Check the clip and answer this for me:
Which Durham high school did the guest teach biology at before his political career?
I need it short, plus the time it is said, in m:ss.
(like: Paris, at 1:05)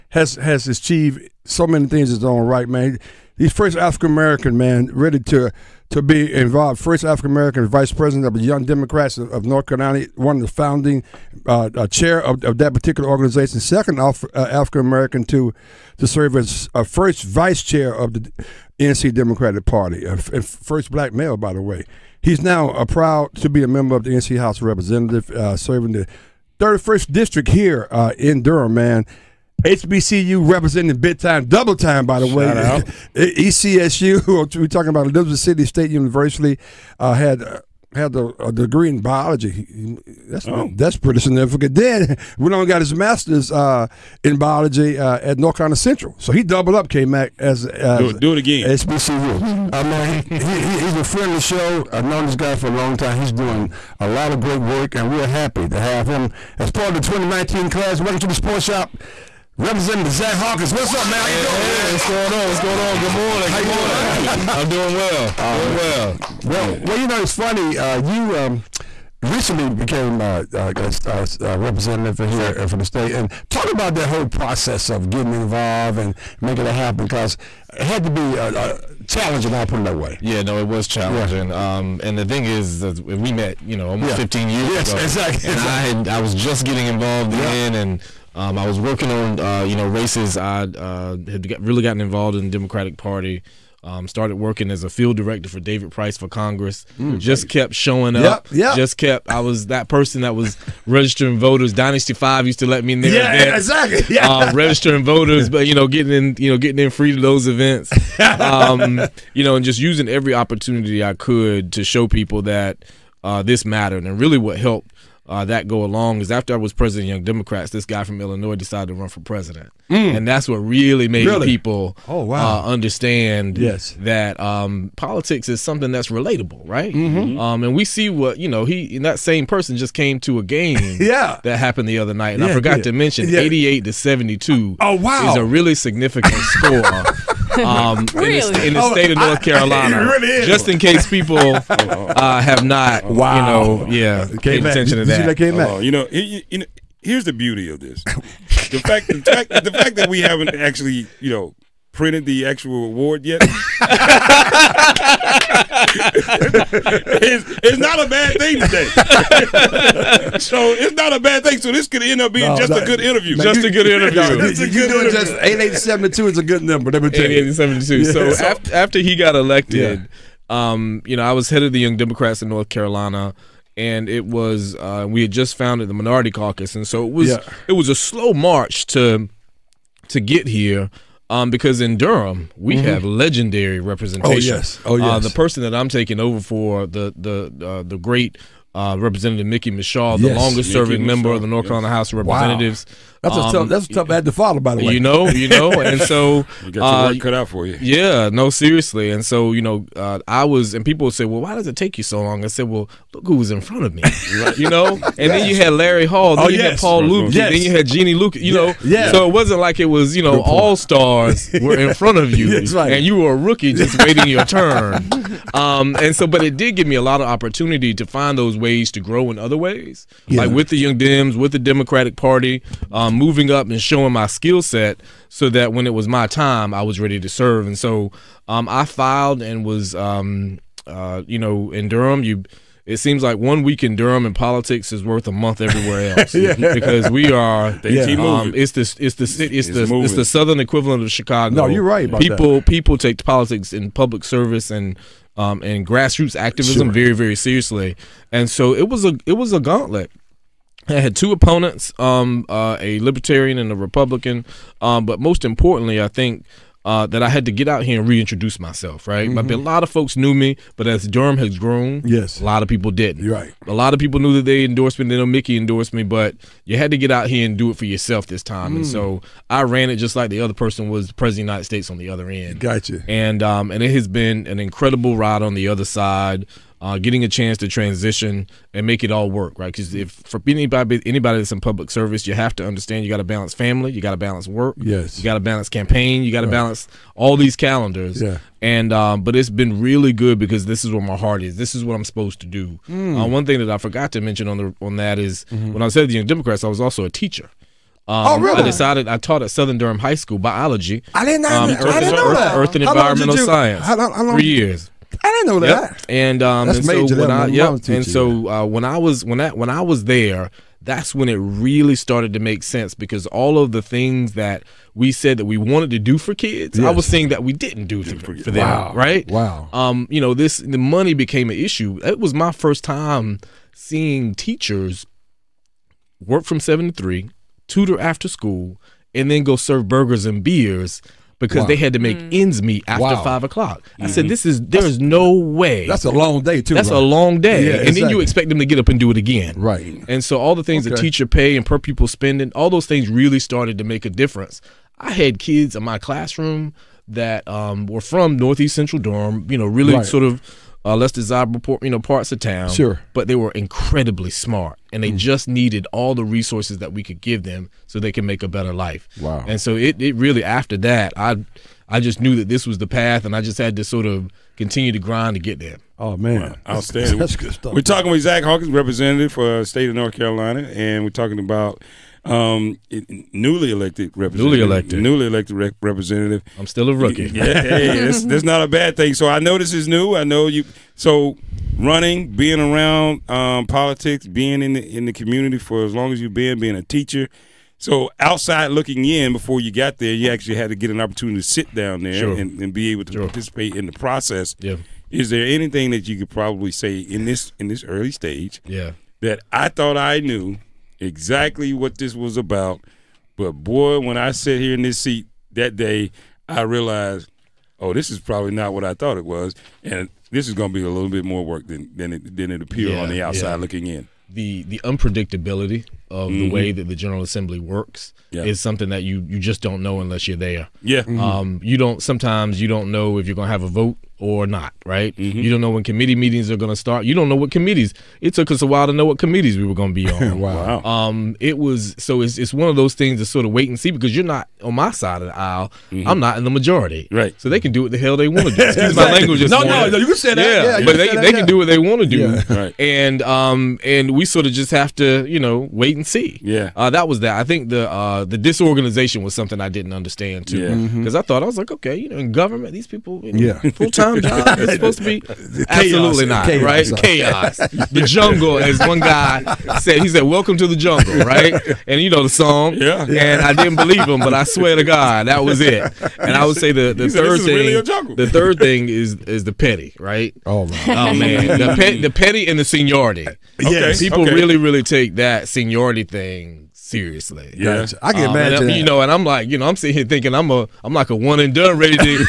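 Southern Durham High School, at 4:59.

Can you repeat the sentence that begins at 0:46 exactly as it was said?
So he doubled up, came back as, as do, it, do it again.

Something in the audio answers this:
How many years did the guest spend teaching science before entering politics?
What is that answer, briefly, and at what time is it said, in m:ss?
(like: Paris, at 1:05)
3, at 5:04.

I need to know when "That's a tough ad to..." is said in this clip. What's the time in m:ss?
3:13.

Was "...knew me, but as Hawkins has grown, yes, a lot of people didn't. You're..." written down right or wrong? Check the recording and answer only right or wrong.
wrong.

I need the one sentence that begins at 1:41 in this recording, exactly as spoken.
Dynasty Five used to let me in there.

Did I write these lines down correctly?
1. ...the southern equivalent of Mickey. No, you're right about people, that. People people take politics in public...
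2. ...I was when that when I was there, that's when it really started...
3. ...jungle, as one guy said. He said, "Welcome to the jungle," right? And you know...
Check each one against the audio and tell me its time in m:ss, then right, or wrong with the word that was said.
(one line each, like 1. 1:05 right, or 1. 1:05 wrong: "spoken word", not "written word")
1. 4:00 wrong: "Chicago", not "Mickey"
2. 5:08 right
3. 7:38 right.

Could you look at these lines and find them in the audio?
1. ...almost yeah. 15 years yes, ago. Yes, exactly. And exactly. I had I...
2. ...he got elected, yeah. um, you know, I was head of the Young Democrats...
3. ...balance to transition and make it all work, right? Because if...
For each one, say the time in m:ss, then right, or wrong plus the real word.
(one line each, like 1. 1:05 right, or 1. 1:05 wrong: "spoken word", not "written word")
1. 1:23 right
2. 2:48 right
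3. 4:37 wrong: "chance", not "balance".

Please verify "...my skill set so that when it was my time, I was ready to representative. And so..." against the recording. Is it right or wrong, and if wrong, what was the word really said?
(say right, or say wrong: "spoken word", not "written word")
wrong: "serve", not "representative".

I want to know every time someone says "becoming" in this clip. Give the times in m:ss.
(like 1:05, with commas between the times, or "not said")
not said.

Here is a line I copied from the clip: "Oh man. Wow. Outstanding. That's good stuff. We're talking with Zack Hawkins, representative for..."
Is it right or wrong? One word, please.
right.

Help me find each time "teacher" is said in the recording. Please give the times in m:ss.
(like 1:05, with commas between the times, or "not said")
4:57, 5:24, 5:41, 6:26.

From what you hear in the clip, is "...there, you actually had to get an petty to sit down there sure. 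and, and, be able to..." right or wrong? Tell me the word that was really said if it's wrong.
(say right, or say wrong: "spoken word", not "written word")
wrong: "opportunity", not "petty".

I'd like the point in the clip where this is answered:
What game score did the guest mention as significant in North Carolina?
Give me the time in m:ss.
2:13.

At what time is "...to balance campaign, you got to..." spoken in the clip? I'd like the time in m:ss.
4:45.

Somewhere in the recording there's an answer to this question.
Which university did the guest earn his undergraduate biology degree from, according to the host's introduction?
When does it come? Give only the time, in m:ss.
0:35.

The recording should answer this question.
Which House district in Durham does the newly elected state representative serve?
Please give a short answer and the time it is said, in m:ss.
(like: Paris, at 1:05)
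31st, at 0:26.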